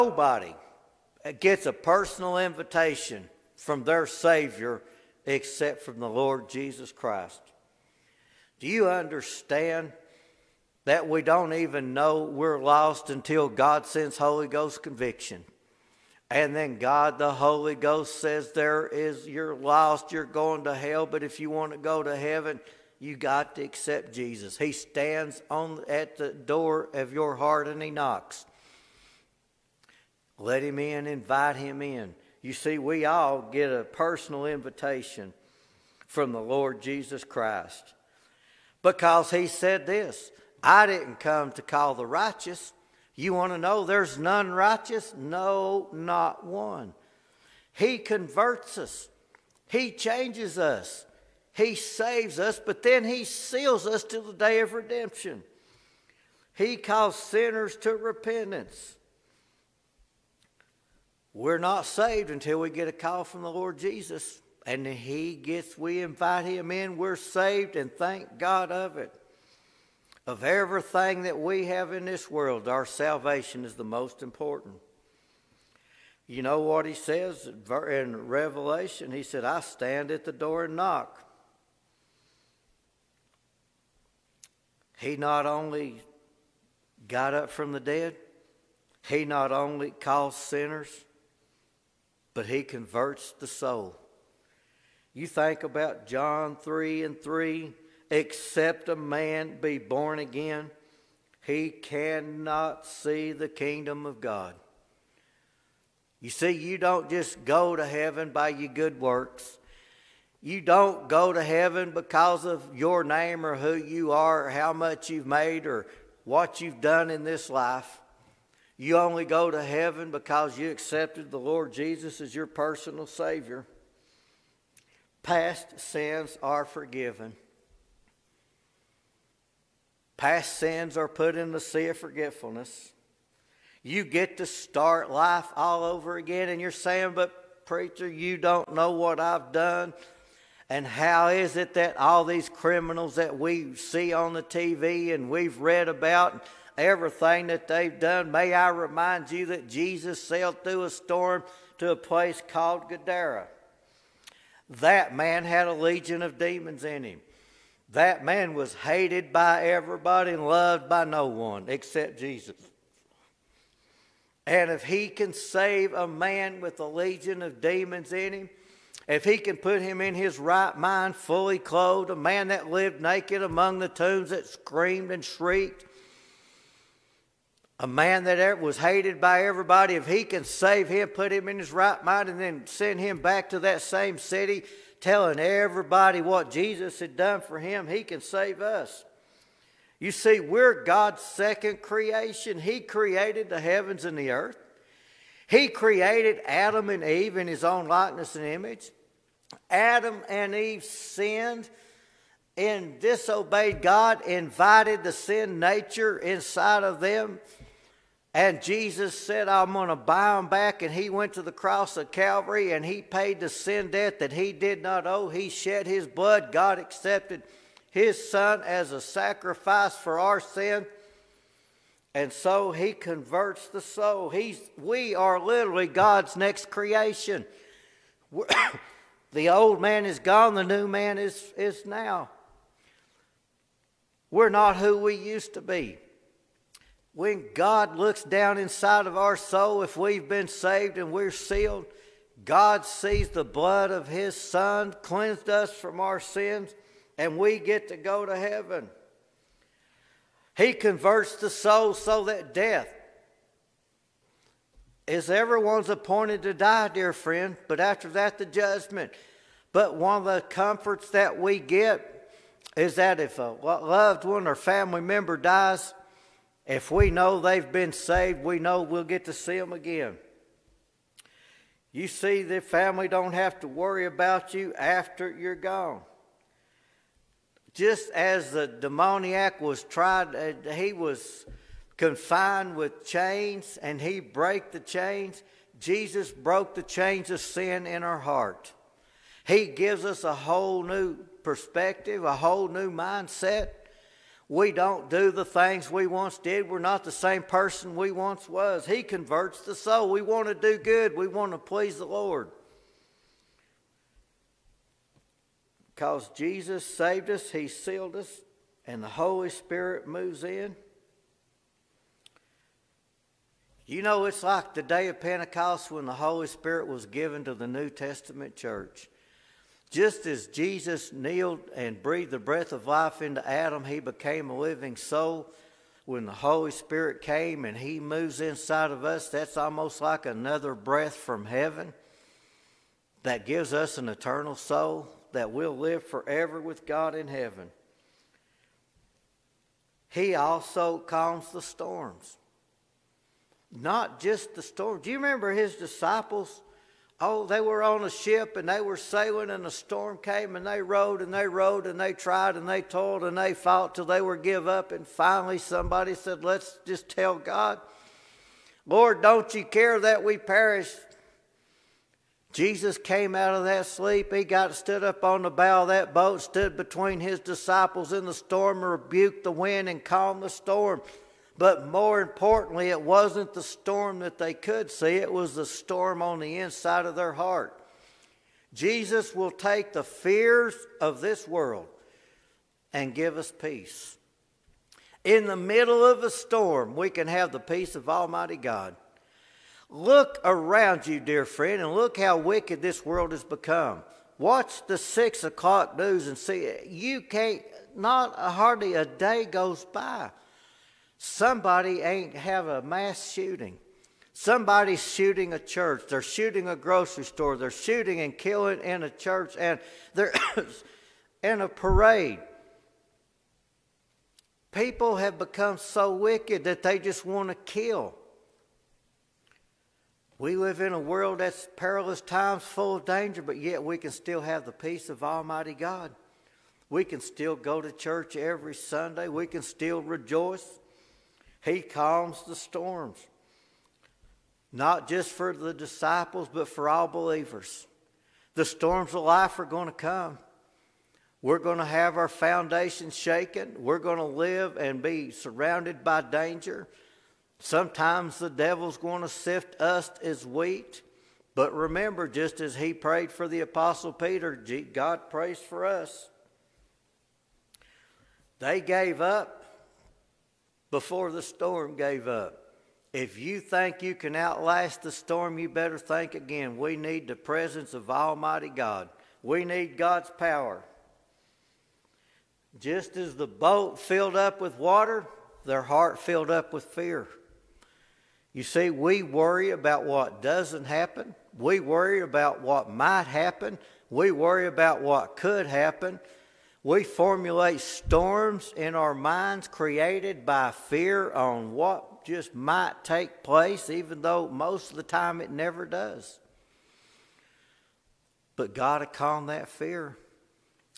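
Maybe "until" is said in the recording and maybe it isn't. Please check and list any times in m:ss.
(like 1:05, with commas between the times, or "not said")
0:13, 1:02.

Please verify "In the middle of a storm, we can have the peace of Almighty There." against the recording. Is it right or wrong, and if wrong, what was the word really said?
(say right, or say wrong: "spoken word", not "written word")
wrong: "God", not "There".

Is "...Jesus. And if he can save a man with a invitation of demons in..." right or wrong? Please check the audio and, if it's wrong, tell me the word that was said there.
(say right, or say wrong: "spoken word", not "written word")
wrong: "legion", not "invitation".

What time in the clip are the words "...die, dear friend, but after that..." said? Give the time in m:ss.
4:16.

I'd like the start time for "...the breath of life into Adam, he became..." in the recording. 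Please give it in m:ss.
5:22.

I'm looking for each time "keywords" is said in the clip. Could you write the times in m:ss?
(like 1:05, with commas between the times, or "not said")
not said.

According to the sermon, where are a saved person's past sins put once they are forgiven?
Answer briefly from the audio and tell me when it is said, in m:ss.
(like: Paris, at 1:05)
The sea of forgetfulness, at 2:11.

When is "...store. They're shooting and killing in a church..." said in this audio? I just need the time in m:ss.
6:47.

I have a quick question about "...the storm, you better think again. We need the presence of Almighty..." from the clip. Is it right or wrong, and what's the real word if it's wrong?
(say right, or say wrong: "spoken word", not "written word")
right.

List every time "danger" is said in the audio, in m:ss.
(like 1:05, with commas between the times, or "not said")
7:03, 7:26.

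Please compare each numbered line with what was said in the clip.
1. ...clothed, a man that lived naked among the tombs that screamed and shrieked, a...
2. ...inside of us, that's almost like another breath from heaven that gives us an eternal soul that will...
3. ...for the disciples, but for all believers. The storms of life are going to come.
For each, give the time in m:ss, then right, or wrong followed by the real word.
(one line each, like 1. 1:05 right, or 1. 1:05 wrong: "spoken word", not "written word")
1. 2:51 right
2. 5:28 right
3. 7:15 right.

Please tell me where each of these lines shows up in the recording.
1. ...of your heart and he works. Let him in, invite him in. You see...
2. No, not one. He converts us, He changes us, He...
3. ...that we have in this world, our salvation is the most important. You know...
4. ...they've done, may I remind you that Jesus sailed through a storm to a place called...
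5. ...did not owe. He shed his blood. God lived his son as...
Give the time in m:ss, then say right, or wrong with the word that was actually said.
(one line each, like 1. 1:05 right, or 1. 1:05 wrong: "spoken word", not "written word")
1. 0:26 wrong: "knocks", not "works"
2. 0:45 right
3. 1:11 right
4. 2:27 right
5. 3:34 wrong: "accepted", not "lived".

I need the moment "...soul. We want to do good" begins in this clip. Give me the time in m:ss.
4:59.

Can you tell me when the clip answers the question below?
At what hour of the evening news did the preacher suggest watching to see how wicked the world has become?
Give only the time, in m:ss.
6:34.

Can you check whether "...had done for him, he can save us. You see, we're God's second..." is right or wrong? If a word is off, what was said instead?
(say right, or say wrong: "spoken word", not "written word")
right.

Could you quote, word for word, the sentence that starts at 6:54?
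People have become so wicked that they just want to kill.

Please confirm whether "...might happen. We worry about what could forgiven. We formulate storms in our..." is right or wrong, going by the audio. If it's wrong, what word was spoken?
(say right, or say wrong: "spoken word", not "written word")
wrong: "happen", not "forgiven".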